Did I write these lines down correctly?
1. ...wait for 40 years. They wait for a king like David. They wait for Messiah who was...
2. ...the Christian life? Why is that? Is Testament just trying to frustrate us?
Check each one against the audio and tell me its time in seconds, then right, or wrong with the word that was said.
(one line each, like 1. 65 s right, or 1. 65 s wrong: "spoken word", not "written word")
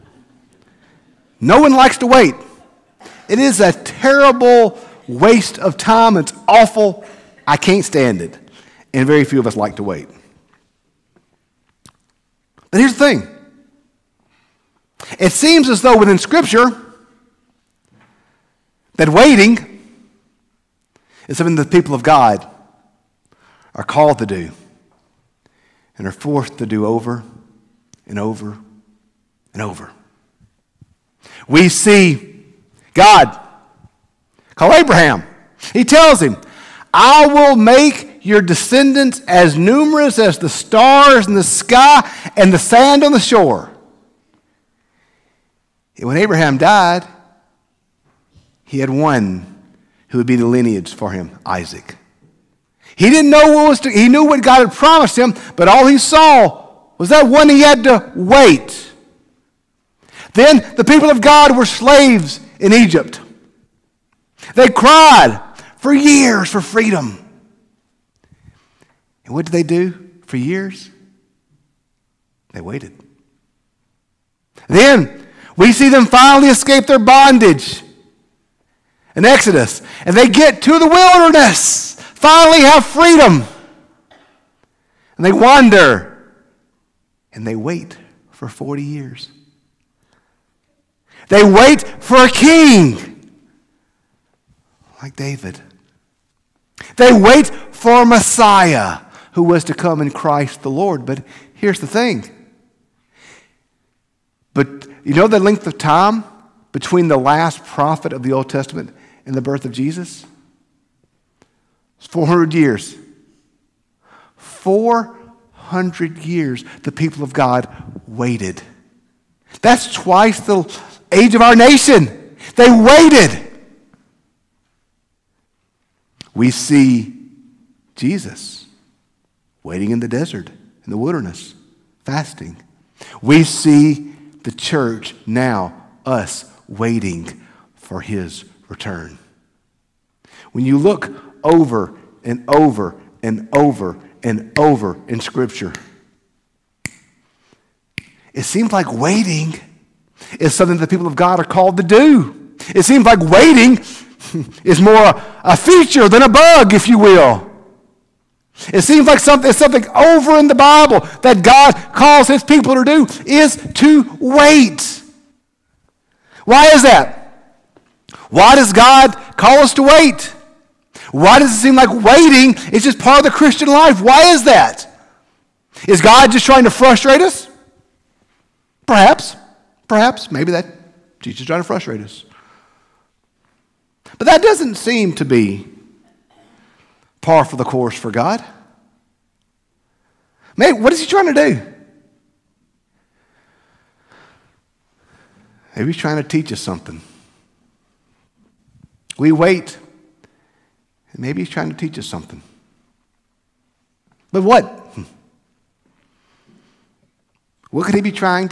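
1. 87 s right
2. 173 s wrong: "God", not "Testament".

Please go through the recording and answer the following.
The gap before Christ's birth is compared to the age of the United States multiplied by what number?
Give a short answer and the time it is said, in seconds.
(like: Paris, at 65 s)
twice, at 119 s.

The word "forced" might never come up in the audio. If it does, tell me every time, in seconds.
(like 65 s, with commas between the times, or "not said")
26 s.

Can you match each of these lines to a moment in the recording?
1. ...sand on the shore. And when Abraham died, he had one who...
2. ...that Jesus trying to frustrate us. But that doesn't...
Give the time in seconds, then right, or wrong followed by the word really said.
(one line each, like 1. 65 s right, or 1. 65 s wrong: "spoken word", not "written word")
1. 42 s right
2. 180 s right.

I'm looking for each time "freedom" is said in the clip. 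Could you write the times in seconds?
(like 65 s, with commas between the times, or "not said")
66 s, 82 s.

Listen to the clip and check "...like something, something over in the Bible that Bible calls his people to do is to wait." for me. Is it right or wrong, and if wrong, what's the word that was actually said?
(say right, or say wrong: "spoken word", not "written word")
wrong: "God", not "Bible".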